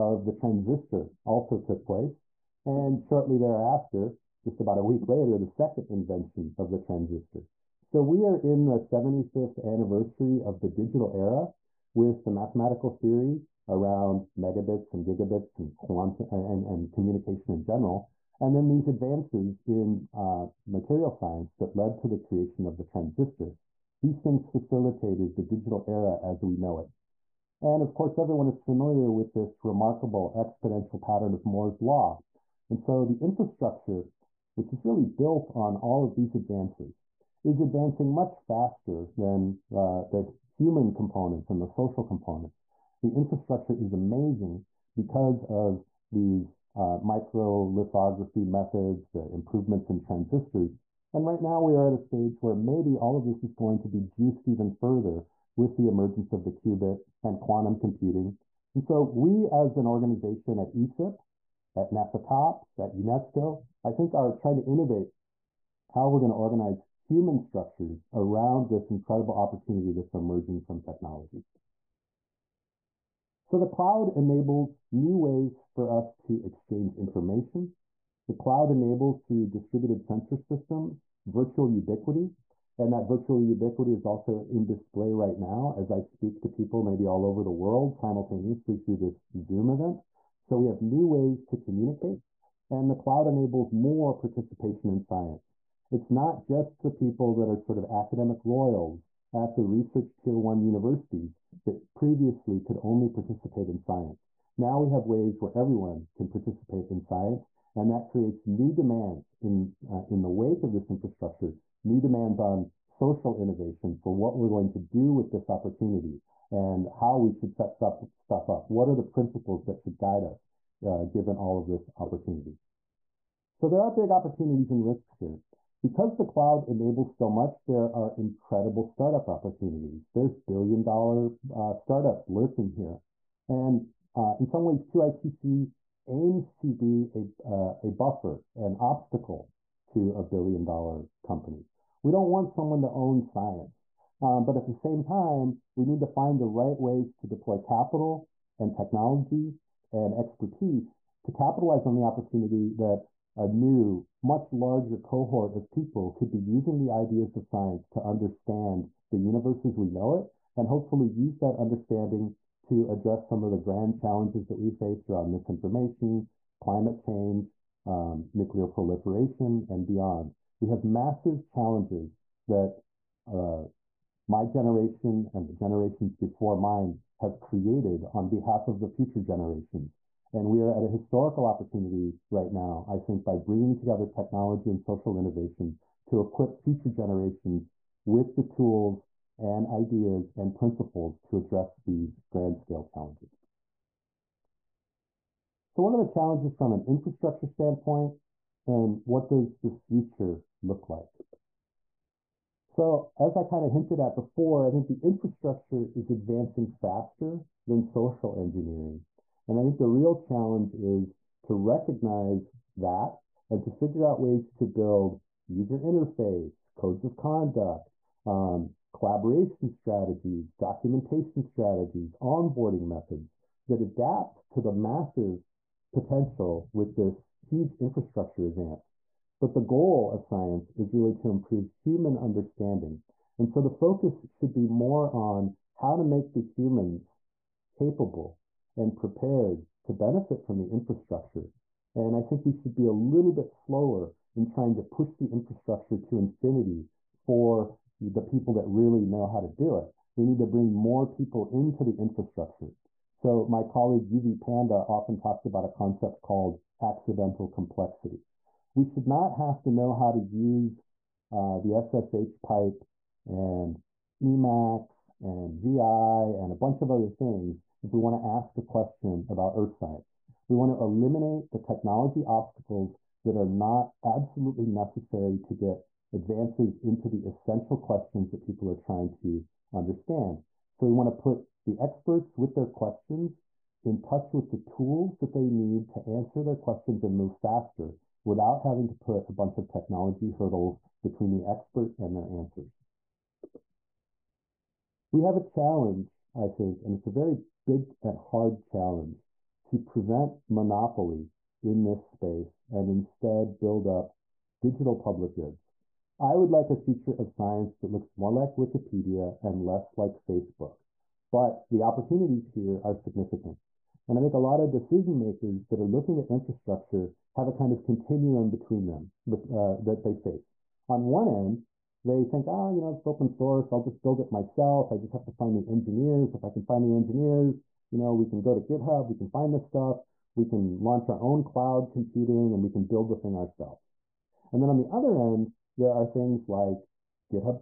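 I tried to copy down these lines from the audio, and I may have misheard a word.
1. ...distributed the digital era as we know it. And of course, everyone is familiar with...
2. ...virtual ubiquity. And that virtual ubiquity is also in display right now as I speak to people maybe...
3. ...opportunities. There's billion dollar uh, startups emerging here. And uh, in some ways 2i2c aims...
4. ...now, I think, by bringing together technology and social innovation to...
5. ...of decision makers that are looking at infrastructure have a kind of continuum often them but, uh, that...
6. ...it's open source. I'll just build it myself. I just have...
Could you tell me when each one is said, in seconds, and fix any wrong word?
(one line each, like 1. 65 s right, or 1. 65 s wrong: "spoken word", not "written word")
1. 24 s wrong: "facilitated", not "distributed"
2. 81 s right
3. 129 s wrong: "lurking", not "emerging"
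4. 182 s right
5. 314 s wrong: "between", not "often"
6. 322 s right.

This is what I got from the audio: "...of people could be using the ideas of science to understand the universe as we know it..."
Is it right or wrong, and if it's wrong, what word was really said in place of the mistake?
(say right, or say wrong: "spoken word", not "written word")
right.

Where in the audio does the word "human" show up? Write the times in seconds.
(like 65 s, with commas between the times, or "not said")
40 s, 66 s, 231 s, 236 s.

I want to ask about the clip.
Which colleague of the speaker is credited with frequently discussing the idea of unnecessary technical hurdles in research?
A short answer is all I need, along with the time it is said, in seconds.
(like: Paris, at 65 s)
Yuvi Panda, at 254 s.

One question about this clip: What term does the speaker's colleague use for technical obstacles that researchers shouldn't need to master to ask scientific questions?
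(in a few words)
accidental complexity.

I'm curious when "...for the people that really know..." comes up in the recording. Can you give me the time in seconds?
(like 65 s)
247 s.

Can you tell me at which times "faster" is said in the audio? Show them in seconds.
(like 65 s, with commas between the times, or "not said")
38 s, 206 s, 287 s.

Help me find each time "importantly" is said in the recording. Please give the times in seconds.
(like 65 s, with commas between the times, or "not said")
not said.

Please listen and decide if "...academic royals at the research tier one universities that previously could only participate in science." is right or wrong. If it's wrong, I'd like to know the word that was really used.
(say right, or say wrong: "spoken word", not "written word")
right.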